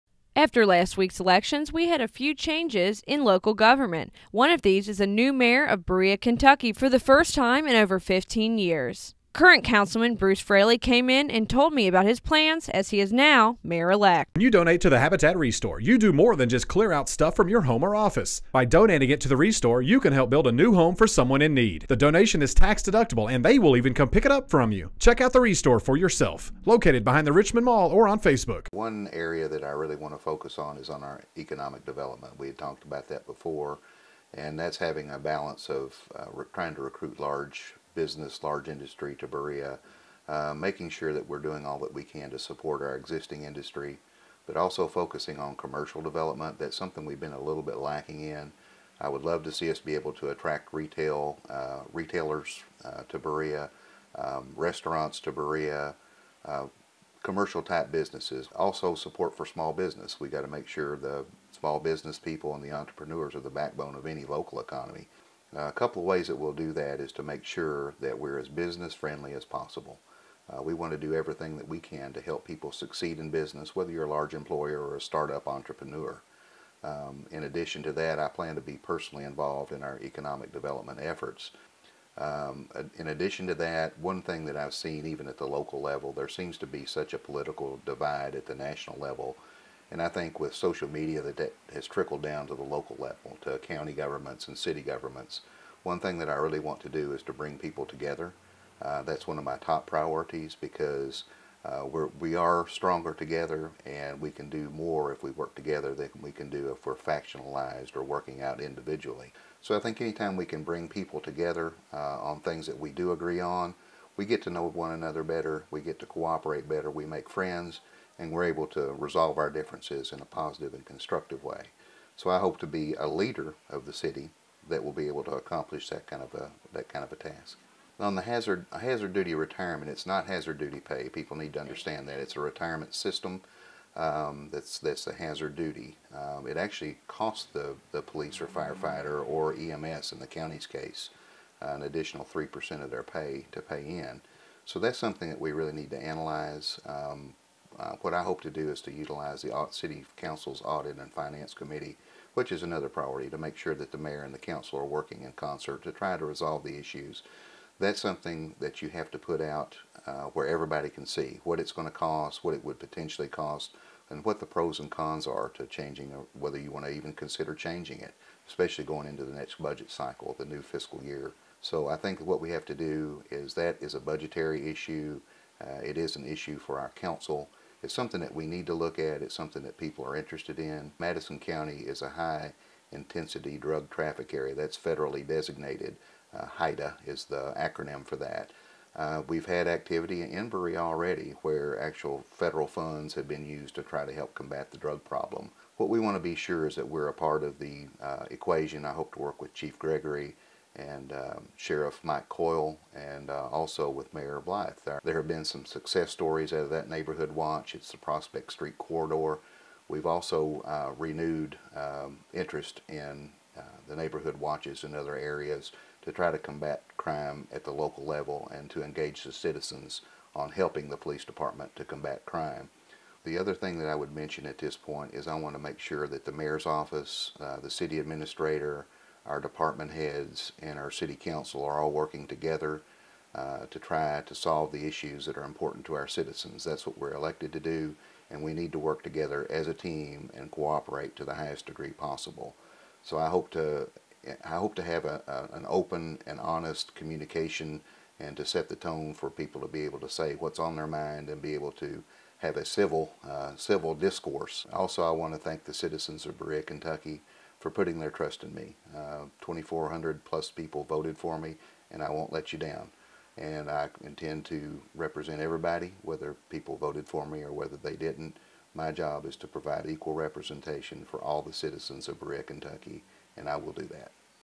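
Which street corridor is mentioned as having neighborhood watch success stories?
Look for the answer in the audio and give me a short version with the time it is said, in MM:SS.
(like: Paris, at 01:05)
Prospect Street, at 03:27.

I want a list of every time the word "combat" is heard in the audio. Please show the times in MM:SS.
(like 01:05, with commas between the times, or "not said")
03:14, 03:36, 03:41.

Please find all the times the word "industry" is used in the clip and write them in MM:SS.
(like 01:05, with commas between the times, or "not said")
00:38, 00:43.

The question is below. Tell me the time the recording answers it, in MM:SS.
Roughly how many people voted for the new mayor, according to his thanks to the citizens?
04:19.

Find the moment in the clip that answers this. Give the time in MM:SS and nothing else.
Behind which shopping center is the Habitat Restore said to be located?
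00:27.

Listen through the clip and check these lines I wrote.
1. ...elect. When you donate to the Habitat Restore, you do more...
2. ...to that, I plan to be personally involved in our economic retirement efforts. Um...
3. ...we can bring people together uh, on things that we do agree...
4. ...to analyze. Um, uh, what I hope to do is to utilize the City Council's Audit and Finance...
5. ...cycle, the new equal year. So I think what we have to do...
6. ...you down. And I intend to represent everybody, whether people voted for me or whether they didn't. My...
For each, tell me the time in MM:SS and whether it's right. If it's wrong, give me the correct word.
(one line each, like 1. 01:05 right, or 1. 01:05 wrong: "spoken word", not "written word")
1. 00:13 right
2. 01:17 wrong: "development", not "retirement"
3. 01:50 right
4. 02:25 right
5. 02:49 wrong: "fiscal", not "equal"
6. 04:22 right.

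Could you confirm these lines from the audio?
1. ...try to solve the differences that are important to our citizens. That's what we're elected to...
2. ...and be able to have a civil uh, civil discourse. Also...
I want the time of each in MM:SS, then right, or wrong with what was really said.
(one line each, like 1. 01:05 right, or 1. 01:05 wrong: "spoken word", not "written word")
1. 03:53 wrong: "issues", not "differences"
2. 04:11 right.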